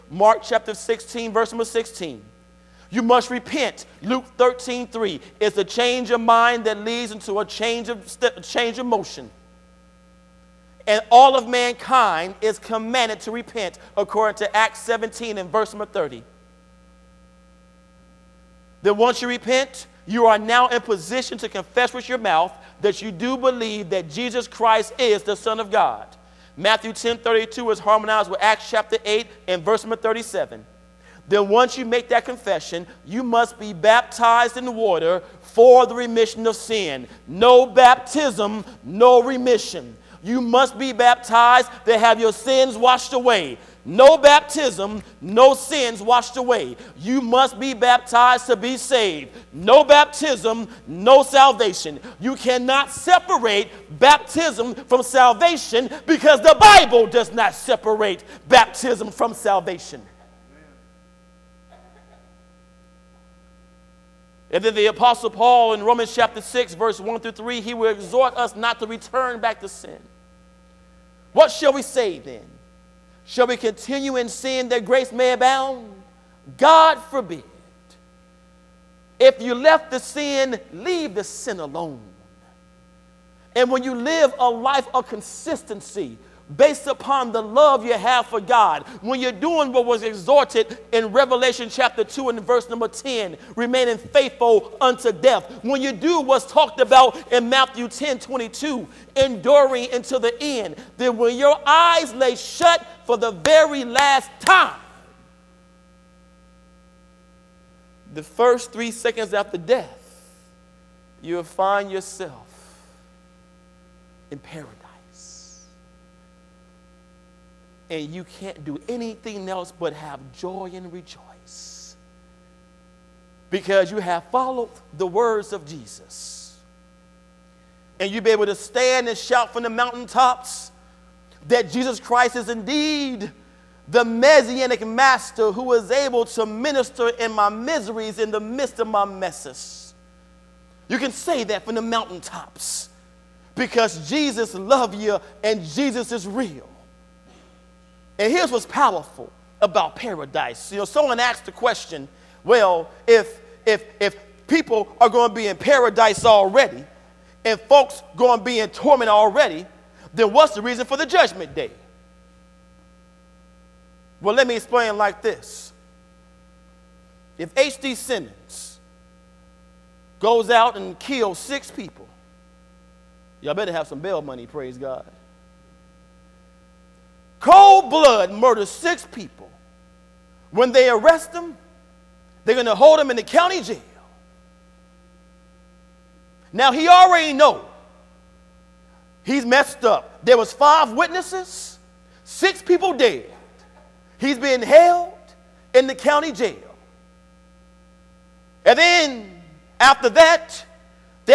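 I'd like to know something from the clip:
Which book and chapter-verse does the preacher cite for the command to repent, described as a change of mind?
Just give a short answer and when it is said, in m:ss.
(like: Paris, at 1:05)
Luke 13:3, at 0:04.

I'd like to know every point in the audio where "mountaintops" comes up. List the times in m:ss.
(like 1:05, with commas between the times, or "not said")
2:09, 2:21.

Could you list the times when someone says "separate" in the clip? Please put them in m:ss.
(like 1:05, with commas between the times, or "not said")
0:52, 0:57.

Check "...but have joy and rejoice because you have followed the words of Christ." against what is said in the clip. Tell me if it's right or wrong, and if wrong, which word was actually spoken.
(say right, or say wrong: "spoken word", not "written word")
wrong: "Jesus", not "Christ".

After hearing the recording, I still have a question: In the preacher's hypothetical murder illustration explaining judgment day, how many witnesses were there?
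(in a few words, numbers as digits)
5.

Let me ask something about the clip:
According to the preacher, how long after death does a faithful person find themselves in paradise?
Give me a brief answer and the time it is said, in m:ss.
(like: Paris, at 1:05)
first 3 seconds, at 1:48.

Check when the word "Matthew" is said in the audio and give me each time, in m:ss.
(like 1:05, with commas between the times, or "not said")
0:26, 1:37.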